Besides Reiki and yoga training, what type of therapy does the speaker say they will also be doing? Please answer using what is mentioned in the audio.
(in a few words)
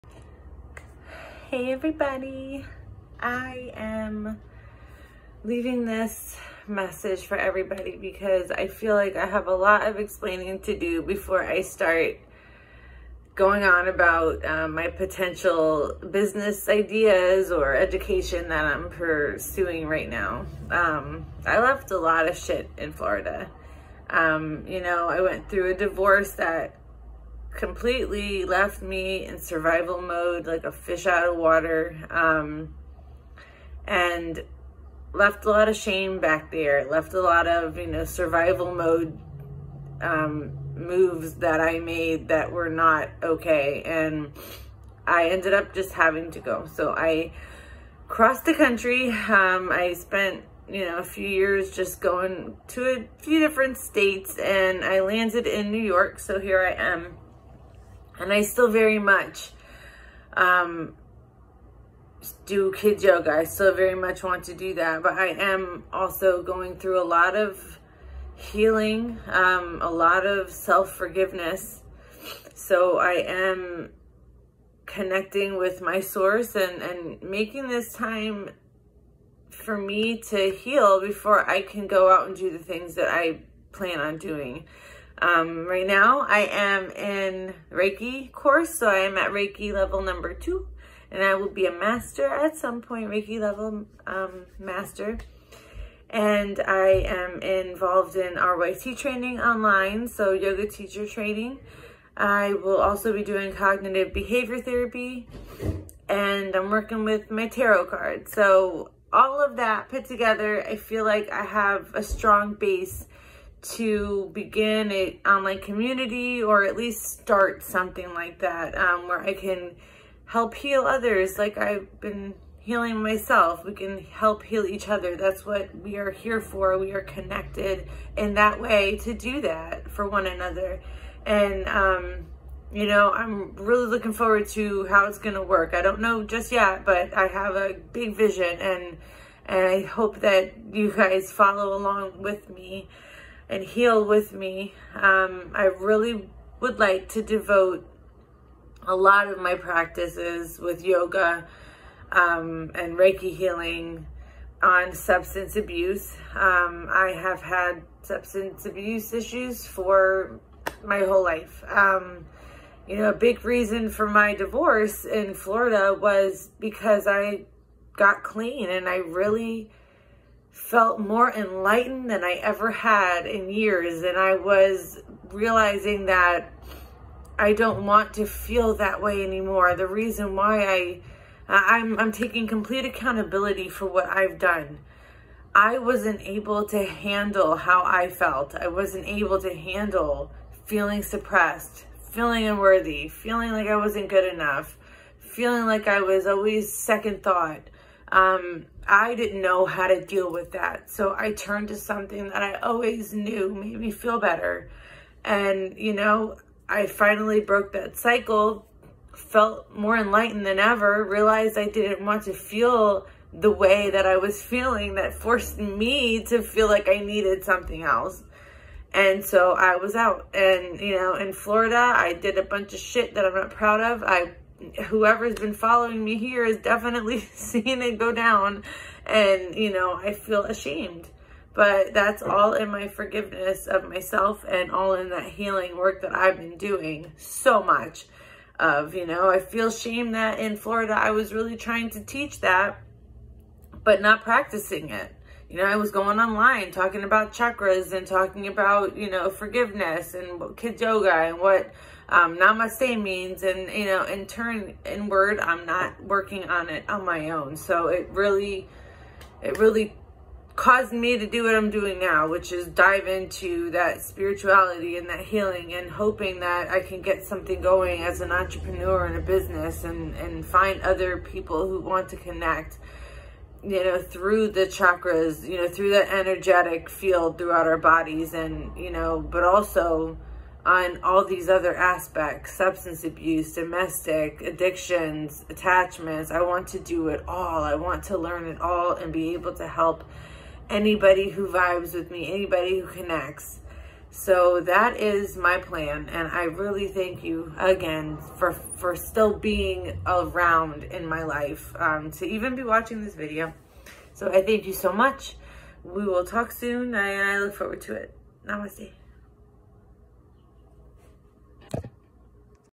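Cognitive behavior therapy.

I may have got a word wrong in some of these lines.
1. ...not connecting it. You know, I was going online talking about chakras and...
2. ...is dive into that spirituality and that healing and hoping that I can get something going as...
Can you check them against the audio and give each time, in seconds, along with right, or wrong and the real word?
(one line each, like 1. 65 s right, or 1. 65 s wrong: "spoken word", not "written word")
1. 244 s wrong: "practicing", not "connecting"
2. 262 s right.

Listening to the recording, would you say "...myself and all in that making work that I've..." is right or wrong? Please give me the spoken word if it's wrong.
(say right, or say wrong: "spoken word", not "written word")
wrong: "healing", not "making".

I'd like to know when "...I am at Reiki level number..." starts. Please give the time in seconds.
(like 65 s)
88 s.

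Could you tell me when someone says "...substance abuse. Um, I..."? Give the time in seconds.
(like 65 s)
154 s.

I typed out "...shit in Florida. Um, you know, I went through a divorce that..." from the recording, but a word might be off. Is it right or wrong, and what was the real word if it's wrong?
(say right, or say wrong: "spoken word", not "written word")
right.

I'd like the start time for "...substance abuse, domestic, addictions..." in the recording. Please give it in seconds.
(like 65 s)
282 s.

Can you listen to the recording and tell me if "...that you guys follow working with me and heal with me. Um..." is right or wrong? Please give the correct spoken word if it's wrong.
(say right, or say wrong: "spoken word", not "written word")
wrong: "along", not "working".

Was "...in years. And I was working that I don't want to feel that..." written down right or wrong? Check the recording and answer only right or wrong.
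wrong.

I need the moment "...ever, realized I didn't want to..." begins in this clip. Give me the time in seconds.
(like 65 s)
210 s.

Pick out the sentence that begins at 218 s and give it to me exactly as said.
And so I was out and, you know, in Florida, I did a bunch of shit that I'm not proud of.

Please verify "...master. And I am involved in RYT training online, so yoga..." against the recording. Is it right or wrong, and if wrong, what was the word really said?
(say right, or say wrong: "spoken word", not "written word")
right.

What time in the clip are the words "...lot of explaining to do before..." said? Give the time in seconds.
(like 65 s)
9 s.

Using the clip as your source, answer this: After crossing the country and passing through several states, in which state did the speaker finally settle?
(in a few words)
New York.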